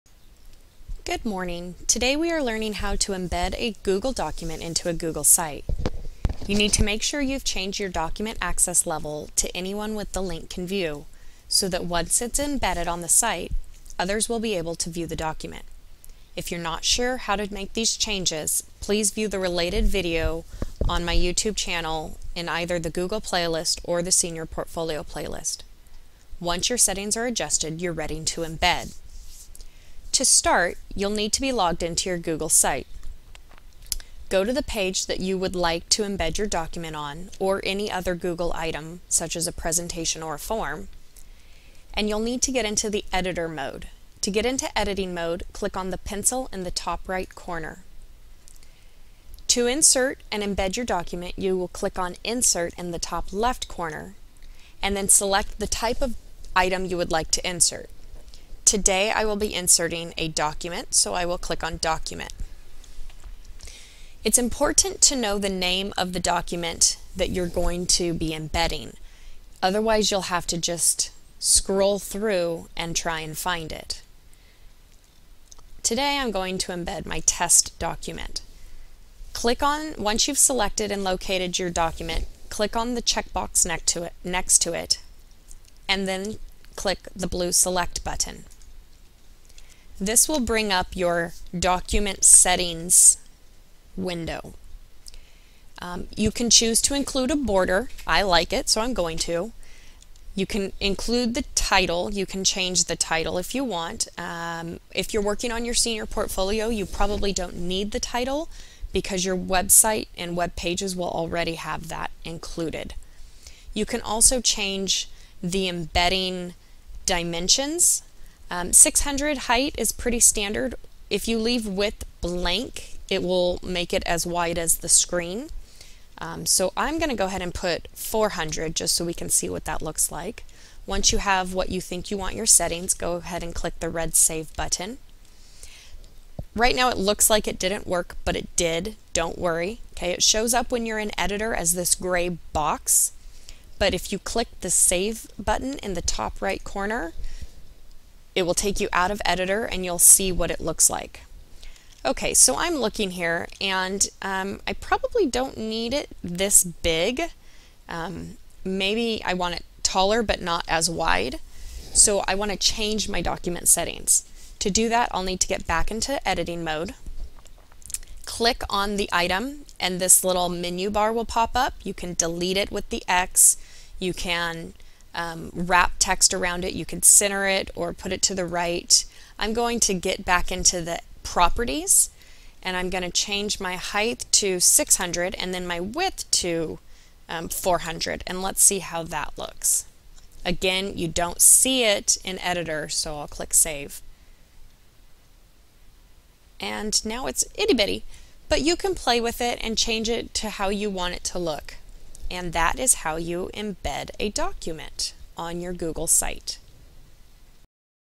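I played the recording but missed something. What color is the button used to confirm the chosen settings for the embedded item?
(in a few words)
red.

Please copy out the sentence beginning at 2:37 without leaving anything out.
Um, maybe I want it taller but not as wide.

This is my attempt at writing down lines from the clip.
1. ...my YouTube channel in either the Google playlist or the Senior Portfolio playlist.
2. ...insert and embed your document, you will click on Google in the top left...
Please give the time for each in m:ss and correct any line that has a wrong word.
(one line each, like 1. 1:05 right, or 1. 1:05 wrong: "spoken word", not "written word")
1. 0:21 right
2. 0:49 wrong: "Insert", not "Google".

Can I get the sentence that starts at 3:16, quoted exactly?
And now it's itty bitty, but you can play with it and change it to how you want it to look.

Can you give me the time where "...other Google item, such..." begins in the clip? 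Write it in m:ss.
0:37.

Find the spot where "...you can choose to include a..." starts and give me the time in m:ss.
1:36.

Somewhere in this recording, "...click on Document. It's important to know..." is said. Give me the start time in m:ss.
1:01.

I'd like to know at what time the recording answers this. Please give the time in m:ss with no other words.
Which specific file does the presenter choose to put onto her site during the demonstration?
1:17.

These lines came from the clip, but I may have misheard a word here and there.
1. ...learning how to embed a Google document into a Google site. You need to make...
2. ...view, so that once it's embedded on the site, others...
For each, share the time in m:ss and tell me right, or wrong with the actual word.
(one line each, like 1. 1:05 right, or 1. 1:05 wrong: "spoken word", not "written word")
1. 0:02 right
2. 0:10 right.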